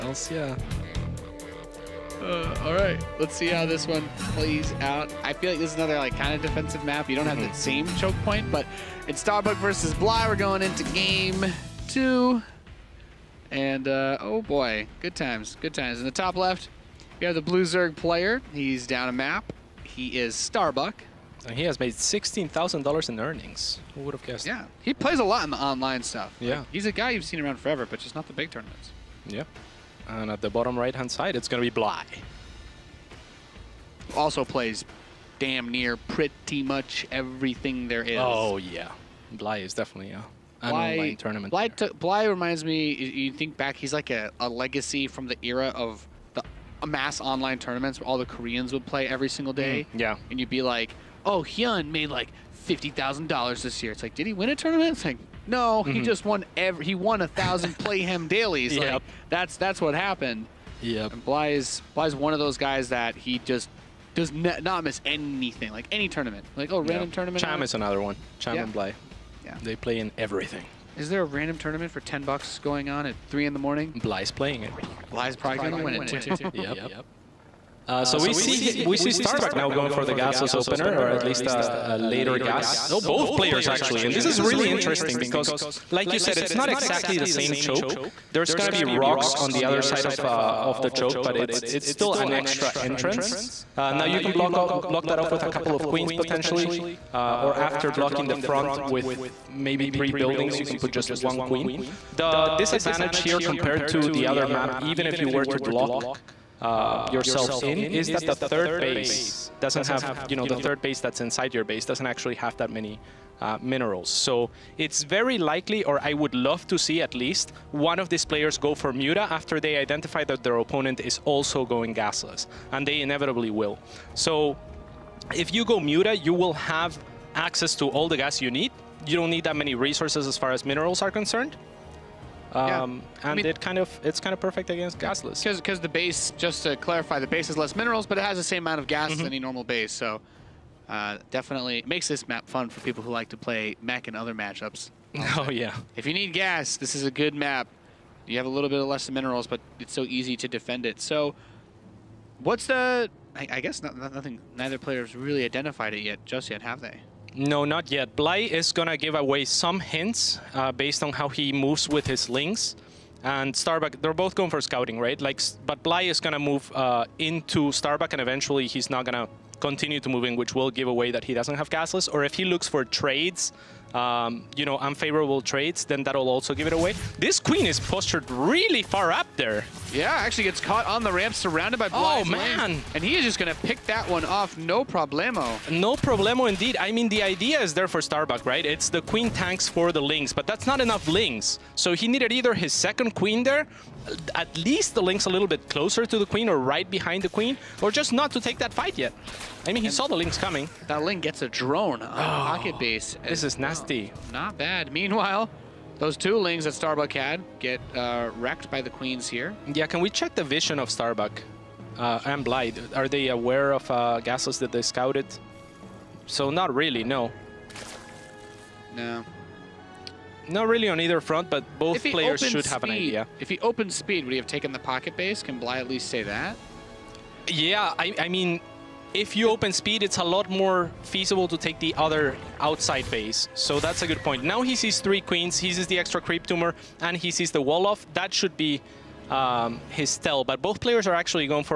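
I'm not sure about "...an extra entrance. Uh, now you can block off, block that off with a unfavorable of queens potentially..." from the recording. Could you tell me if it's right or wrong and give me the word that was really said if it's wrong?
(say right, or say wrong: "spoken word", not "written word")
wrong: "couple", not "unfavorable".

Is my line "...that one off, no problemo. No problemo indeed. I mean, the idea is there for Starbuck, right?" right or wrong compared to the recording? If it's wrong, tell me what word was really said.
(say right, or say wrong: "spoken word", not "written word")
right.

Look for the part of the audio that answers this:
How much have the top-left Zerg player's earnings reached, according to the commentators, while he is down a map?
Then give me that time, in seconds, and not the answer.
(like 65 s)
21 s.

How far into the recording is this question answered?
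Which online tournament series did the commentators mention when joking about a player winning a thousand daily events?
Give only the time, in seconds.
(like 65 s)
57 s.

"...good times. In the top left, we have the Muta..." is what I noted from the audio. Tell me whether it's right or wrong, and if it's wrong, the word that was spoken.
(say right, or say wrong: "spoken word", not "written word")
wrong: "Blue", not "Muta".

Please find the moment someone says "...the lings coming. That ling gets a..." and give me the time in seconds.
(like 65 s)
200 s.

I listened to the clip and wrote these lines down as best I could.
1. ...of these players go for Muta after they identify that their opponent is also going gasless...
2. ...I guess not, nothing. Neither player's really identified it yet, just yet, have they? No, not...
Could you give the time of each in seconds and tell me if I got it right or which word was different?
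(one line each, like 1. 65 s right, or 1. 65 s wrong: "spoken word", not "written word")
1. 117 s right
2. 153 s right.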